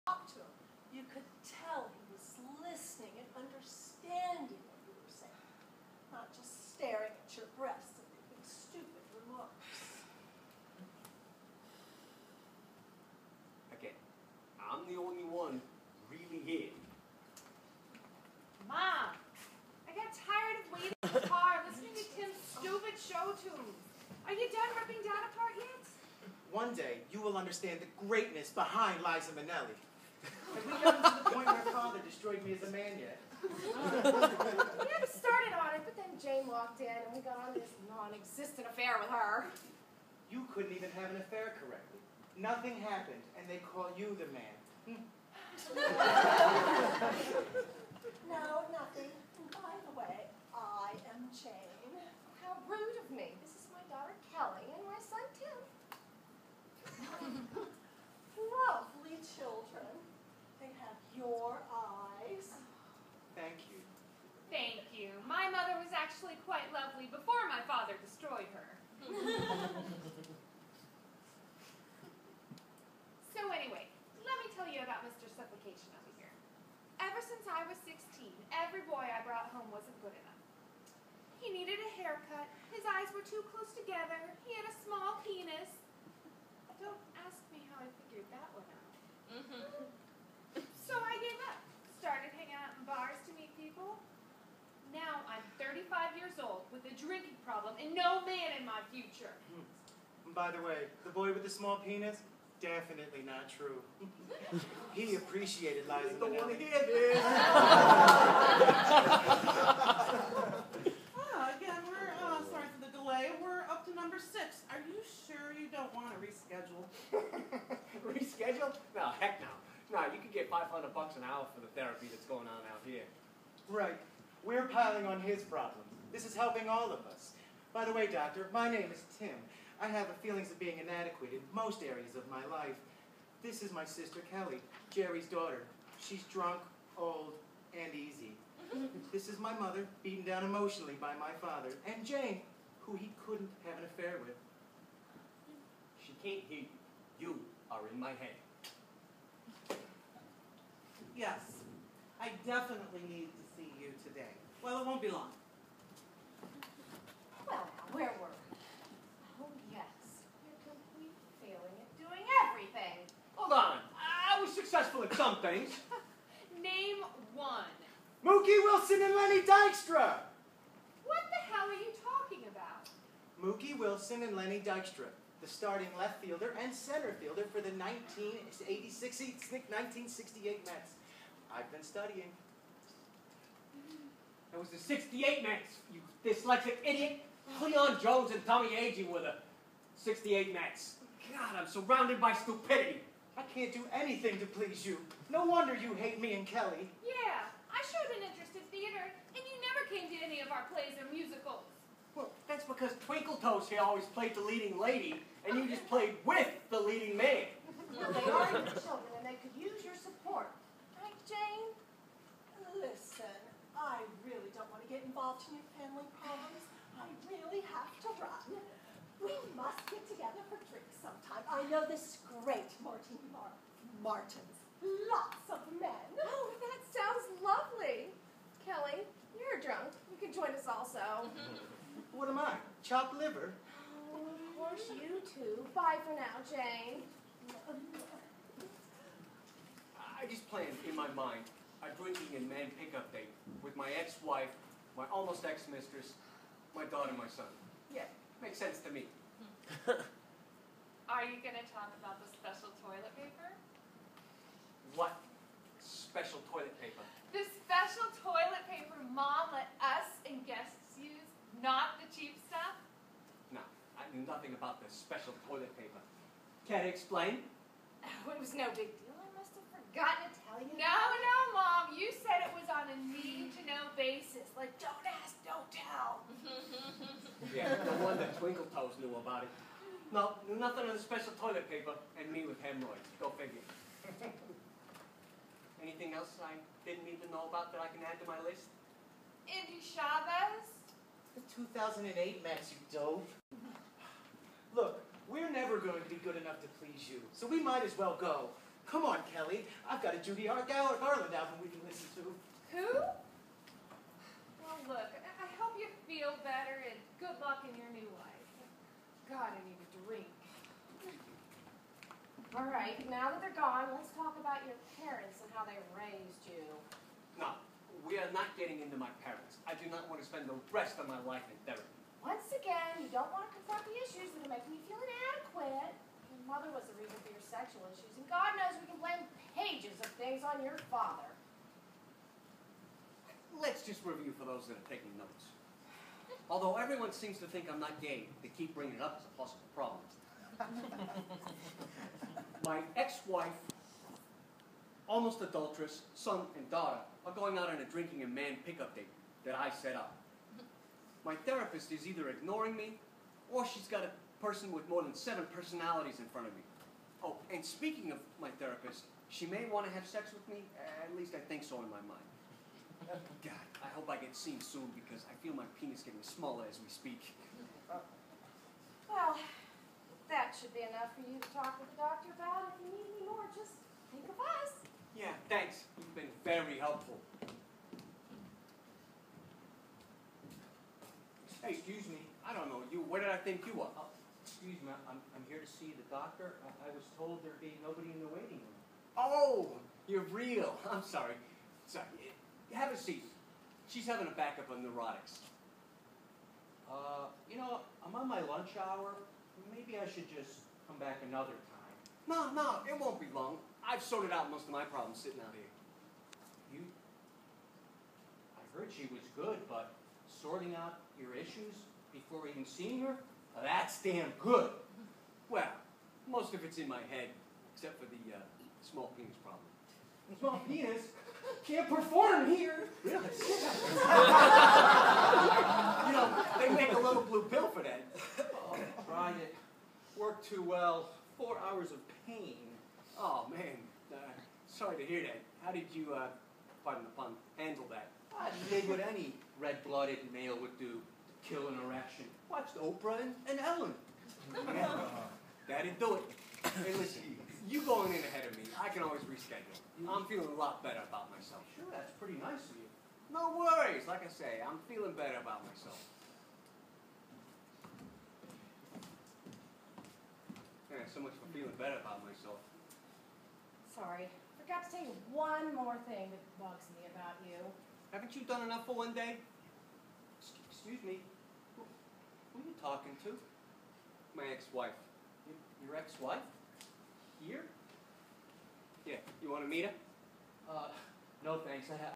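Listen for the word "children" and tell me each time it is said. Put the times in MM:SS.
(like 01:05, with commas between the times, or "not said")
00:59, 03:28.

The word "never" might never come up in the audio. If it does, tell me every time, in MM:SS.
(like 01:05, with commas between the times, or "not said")
03:19, 04:55.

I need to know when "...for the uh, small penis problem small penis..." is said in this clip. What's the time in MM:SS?
06:57.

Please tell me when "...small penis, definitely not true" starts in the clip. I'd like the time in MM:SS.
01:41.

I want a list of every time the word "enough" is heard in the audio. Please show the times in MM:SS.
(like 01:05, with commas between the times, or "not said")
01:20, 04:56, 06:10, 07:48.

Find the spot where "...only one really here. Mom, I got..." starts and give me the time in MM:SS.
00:14.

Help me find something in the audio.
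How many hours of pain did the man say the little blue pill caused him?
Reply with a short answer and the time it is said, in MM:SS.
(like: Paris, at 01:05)
4, at 07:11.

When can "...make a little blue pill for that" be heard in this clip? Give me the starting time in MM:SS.
07:06.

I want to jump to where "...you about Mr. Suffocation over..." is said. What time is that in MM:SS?
01:14.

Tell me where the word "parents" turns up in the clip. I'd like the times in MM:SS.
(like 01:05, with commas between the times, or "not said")
05:14, 05:19.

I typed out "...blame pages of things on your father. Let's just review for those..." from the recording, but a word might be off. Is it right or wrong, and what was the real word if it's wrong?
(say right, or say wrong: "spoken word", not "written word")
right.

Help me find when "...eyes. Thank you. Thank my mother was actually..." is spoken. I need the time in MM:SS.
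01:01.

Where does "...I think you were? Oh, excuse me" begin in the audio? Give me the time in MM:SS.
06:23.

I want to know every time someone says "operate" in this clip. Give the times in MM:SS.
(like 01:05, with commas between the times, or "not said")
not said.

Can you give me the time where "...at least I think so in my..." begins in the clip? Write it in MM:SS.
06:01.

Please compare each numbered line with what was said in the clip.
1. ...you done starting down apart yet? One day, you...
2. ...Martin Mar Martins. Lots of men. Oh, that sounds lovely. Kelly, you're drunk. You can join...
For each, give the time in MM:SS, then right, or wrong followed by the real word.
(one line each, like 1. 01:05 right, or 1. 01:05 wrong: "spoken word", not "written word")
1. 00:24 wrong: "ripping", not "starting"
2. 03:42 right.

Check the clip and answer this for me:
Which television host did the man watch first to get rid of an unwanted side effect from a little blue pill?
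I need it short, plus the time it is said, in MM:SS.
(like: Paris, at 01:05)
Oprah, at 07:22.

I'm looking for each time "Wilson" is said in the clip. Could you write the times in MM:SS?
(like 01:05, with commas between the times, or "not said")
02:48, 02:53.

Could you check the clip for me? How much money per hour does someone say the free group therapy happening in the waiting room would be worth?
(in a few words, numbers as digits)
$500.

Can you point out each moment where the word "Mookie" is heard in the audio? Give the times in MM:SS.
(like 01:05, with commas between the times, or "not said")
02:48, 02:53.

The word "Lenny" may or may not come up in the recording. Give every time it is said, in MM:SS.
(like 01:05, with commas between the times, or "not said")
02:49, 02:54.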